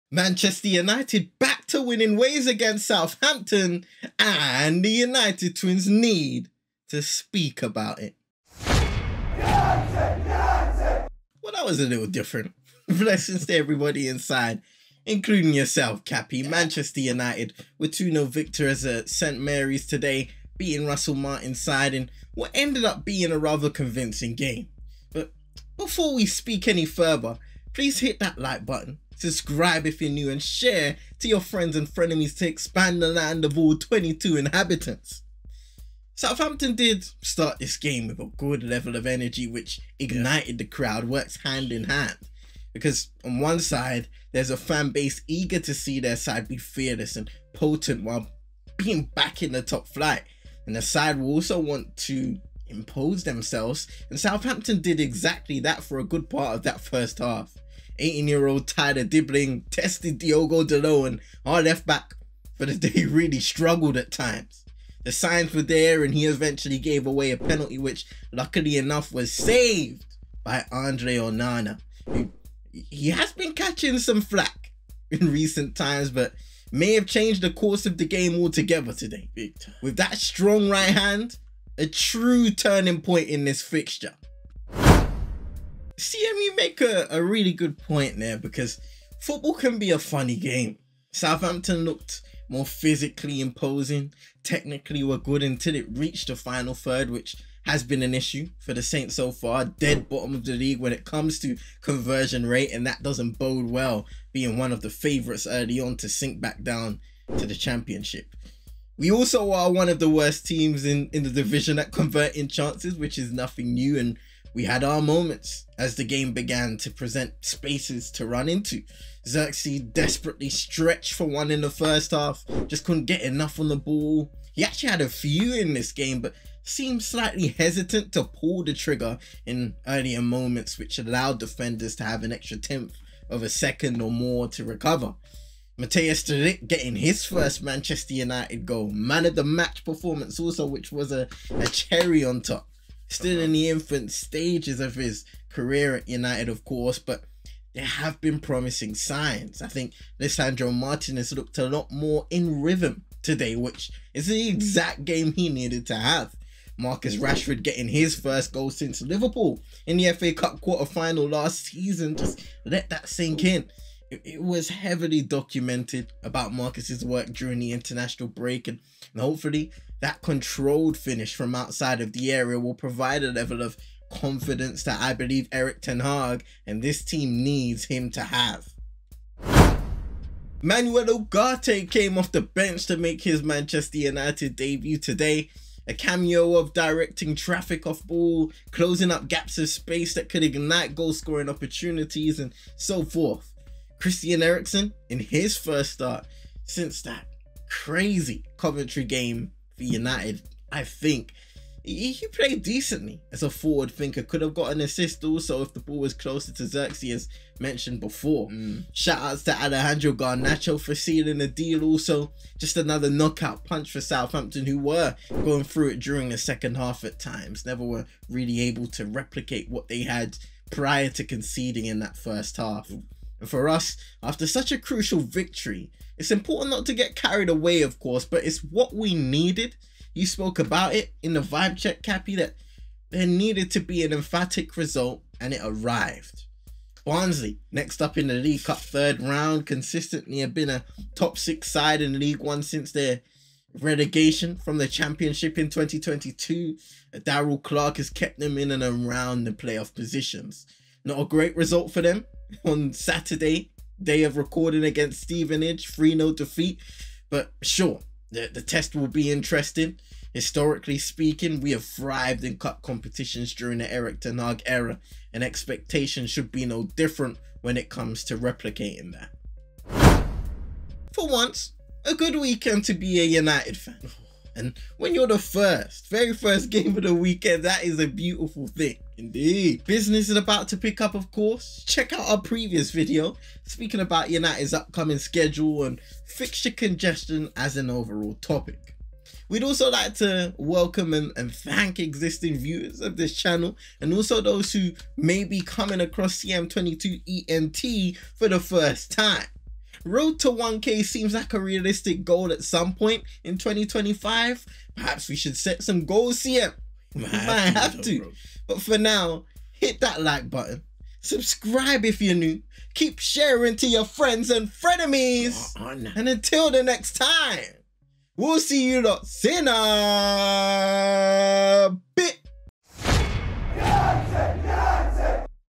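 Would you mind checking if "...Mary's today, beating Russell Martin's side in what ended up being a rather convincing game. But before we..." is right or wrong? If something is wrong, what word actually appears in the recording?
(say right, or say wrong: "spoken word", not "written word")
right.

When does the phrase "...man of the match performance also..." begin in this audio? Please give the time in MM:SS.
02:18.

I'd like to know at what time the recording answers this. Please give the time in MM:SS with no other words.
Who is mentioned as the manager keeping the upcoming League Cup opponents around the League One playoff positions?
04:07.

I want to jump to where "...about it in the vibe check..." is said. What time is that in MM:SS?
03:50.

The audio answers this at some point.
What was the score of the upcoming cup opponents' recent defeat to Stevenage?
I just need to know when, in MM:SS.
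04:15.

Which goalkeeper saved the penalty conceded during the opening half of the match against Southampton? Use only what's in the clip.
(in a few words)
Andre Onana.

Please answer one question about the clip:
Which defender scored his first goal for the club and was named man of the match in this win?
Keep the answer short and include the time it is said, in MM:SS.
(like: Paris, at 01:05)
Matthijs de Ligt, at 02:15.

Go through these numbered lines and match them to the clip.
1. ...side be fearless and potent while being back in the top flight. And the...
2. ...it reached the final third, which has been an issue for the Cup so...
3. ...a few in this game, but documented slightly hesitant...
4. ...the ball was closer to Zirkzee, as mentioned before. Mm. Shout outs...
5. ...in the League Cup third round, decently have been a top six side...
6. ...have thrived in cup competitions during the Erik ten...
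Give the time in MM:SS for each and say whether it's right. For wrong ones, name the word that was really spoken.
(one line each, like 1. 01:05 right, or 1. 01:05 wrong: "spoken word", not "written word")
1. 00:46 right
2. 01:35 wrong: "Saints", not "Cup"
3. 02:05 wrong: "seemed", not "documented"
4. 03:25 right
5. 03:58 wrong: "consistently", not "decently"
6. 04:21 right.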